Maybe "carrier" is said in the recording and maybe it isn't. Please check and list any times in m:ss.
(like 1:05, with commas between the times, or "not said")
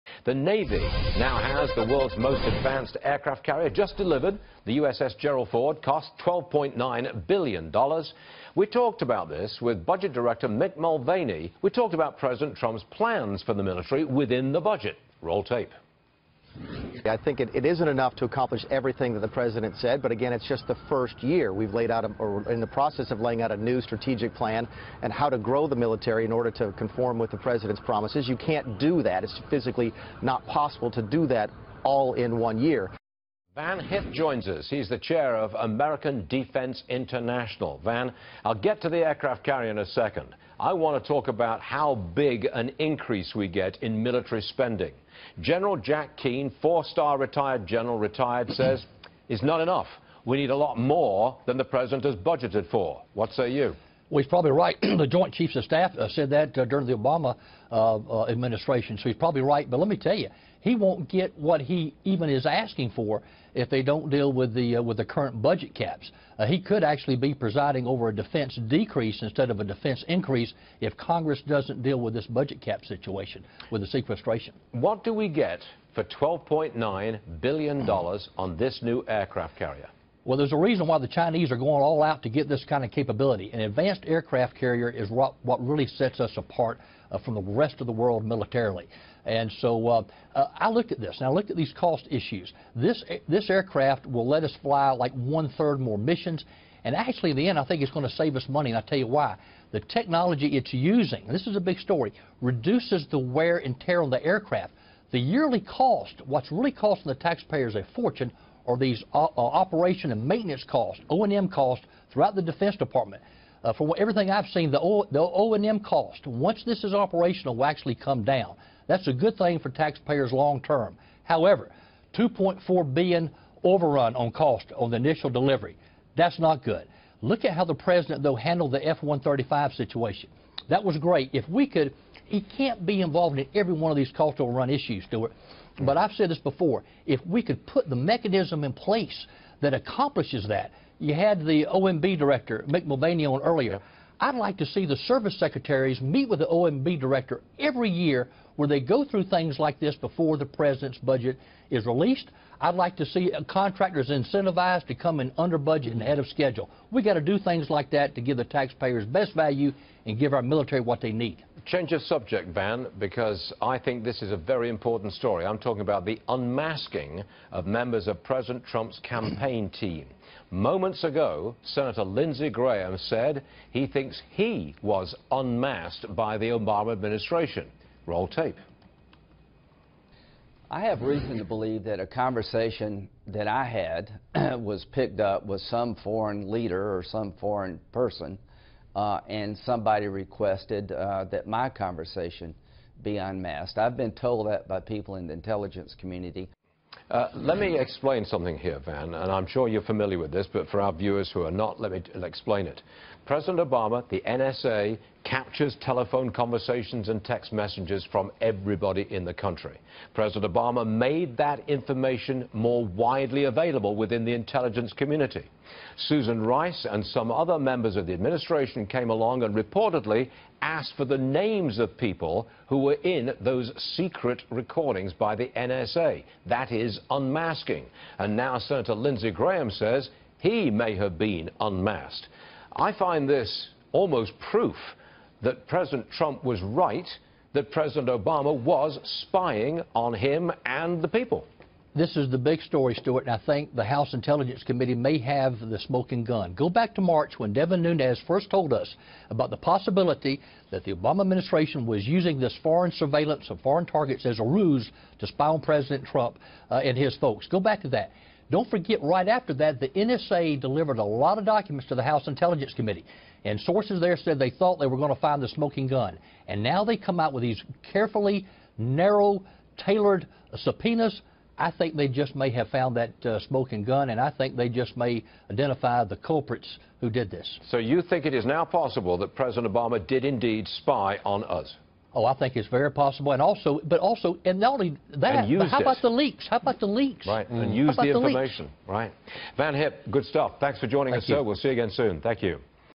0:03, 0:39, 1:19, 1:24.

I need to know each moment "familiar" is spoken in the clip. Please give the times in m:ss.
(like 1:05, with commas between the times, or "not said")
3:19.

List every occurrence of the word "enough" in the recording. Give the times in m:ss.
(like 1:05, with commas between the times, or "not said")
0:17, 0:49.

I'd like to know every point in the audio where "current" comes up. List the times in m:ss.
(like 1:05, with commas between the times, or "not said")
1:05.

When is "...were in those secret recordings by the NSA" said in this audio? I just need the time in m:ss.
3:42.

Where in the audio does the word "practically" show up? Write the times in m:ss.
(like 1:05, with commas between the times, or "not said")
not said.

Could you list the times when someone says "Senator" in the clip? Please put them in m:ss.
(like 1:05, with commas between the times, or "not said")
2:51, 3:48.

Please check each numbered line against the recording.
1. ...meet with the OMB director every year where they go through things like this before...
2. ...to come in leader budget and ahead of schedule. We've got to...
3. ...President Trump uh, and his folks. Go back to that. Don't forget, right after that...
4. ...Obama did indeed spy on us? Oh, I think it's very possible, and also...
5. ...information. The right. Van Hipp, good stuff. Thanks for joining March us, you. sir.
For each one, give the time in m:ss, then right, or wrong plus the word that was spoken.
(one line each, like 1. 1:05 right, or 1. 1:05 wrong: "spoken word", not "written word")
1. 2:25 right
2. 2:34 wrong: "under", not "leader"
3. 4:15 right
4. 4:39 right
5. 4:48 wrong: "Thank", not "March".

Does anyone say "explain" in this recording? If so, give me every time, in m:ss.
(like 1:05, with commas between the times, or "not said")
3:17, 3:22.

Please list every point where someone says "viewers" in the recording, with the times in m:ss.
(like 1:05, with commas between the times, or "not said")
3:20.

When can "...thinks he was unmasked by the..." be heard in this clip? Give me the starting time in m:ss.
2:53.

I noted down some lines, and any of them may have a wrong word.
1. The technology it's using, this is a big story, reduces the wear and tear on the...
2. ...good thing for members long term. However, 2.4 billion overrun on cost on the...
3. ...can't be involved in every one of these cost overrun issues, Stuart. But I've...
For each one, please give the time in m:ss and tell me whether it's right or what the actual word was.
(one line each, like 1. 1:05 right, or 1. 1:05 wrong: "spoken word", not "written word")
1. 1:39 right
2. 1:59 wrong: "taxpayers", not "members"
3. 2:12 right.